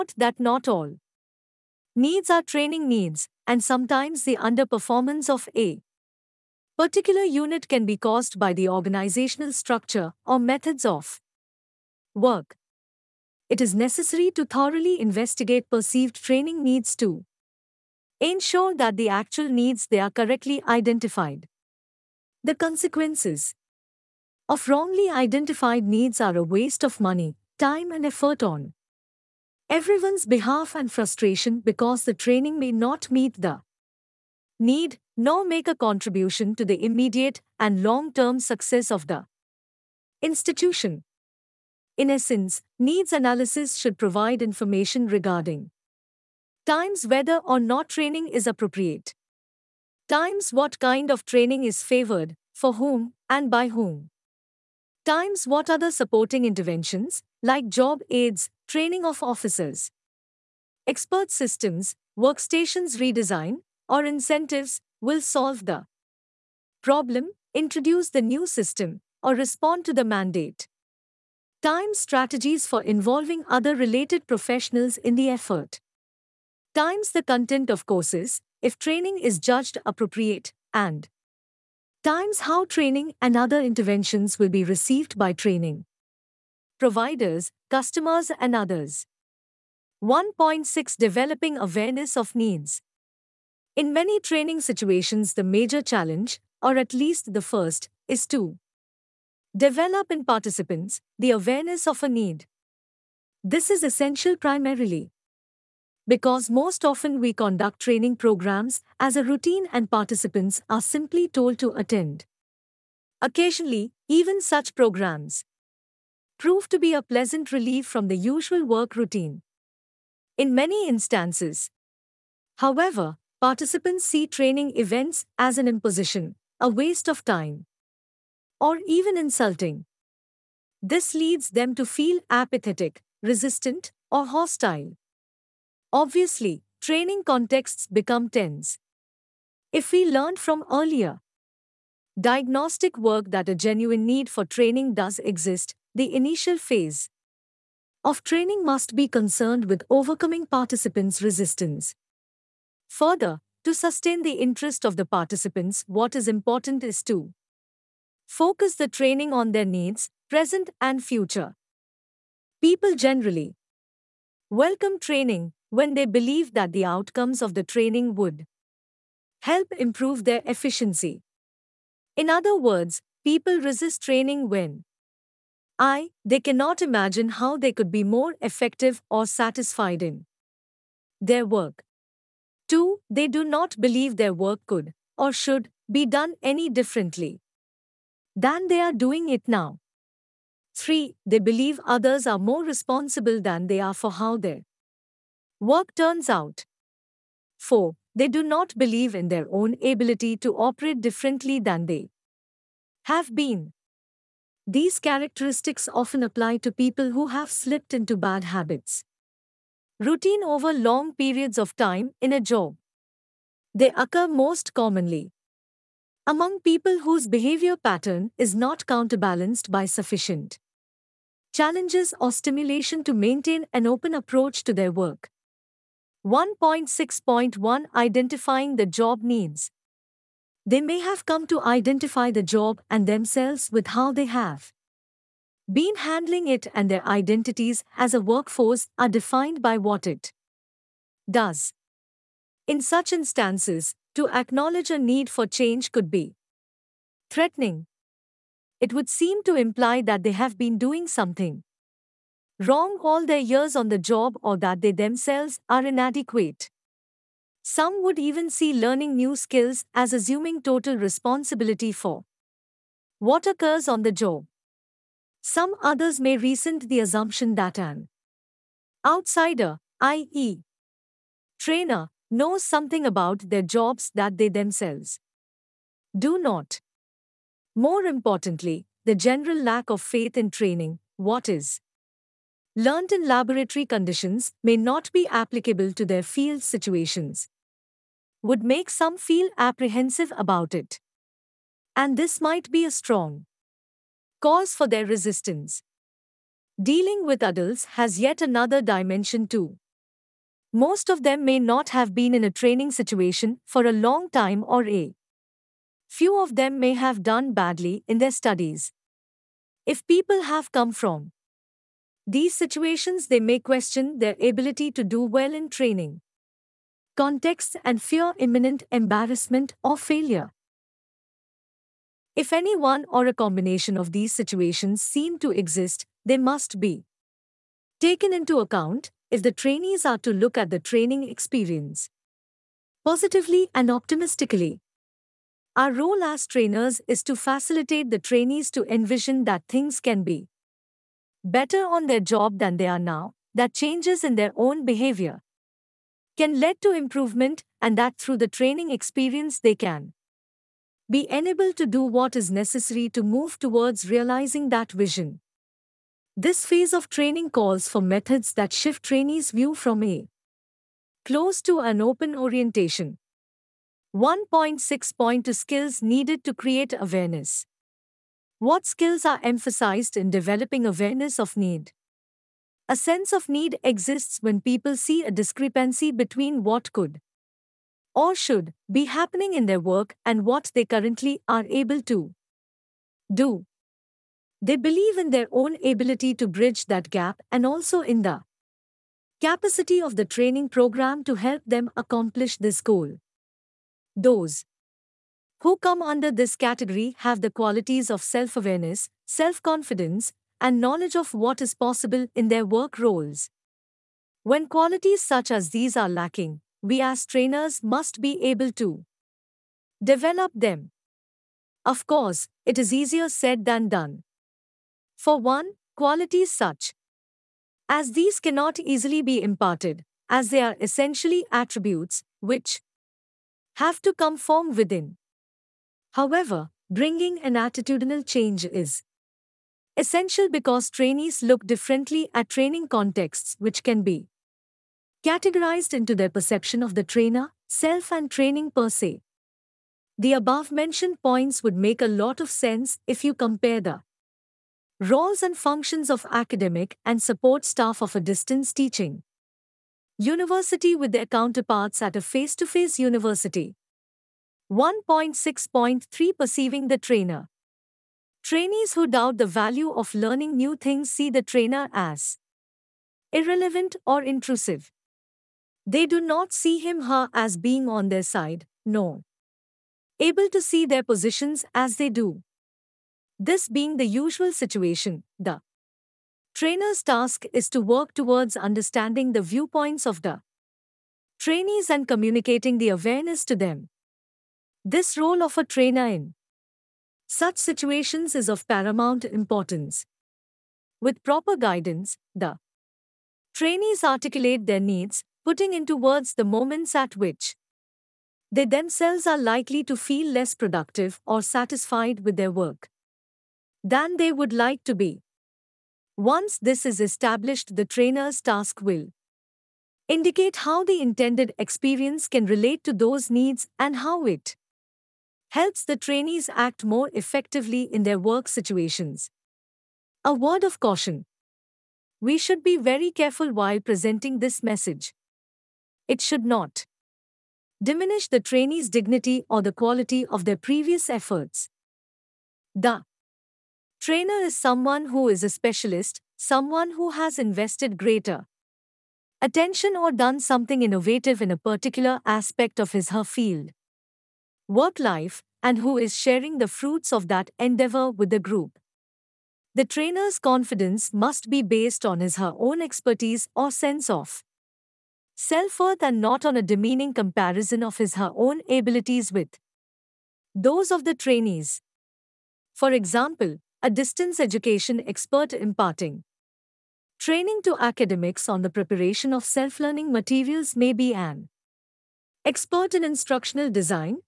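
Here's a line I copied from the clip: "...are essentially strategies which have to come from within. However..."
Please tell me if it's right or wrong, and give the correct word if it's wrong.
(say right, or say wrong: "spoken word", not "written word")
wrong: "attributes", not "strategies".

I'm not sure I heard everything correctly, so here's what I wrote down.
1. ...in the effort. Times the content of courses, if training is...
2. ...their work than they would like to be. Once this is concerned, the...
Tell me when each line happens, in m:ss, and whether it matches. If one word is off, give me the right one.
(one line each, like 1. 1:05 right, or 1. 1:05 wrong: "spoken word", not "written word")
1. 1:14 right
2. 8:22 wrong: "established", not "concerned".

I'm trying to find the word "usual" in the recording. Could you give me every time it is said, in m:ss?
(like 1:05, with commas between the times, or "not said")
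1:58, 7:54.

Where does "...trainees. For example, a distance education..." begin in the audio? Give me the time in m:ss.
9:21.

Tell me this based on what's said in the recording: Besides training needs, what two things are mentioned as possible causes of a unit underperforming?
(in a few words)
organizational structure or methods of work.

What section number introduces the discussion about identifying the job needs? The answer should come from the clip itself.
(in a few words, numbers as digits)
1.6.1.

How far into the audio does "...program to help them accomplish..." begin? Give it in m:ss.
6:30.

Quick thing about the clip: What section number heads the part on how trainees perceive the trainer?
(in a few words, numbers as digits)
1.6.3.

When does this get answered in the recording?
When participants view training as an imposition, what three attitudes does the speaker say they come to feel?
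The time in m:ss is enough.
2:12.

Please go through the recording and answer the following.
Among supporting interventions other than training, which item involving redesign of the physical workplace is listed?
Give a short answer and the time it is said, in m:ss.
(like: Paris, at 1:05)
workstations redesign, at 1:02.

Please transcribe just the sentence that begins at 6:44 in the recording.
When qualities such as these are lacking, we as trainers must be able to develop them.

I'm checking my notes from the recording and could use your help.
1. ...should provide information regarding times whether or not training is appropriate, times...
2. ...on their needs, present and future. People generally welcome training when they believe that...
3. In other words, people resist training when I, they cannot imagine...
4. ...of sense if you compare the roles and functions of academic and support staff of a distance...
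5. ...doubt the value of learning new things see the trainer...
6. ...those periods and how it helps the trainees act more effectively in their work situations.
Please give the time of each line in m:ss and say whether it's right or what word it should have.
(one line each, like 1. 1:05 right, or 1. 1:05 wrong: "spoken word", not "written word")
1. 0:43 right
2. 2:39 right
3. 2:52 right
4. 7:22 right
5. 7:39 right
6. 8:32 wrong: "needs", not "periods".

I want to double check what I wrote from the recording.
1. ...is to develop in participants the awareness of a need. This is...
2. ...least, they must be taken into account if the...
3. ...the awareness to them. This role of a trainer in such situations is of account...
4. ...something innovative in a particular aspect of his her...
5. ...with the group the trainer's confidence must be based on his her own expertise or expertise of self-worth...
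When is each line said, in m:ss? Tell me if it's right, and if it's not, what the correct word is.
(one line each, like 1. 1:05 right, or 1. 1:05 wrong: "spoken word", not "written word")
1. 1:38 right
2. 5:25 wrong: "exist", not "least"
3. 8:02 wrong: "paramount", not "account"
4. 9:00 right
5. 9:08 wrong: "sense", not "expertise".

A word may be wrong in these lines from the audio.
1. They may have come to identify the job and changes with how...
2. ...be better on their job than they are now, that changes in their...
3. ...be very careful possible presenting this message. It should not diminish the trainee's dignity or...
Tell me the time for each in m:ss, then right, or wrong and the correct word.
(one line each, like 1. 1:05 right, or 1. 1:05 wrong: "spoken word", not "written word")
1. 3:50 wrong: "themselves", not "changes"
2. 5:40 right
3. 8:42 wrong: "while", not "possible".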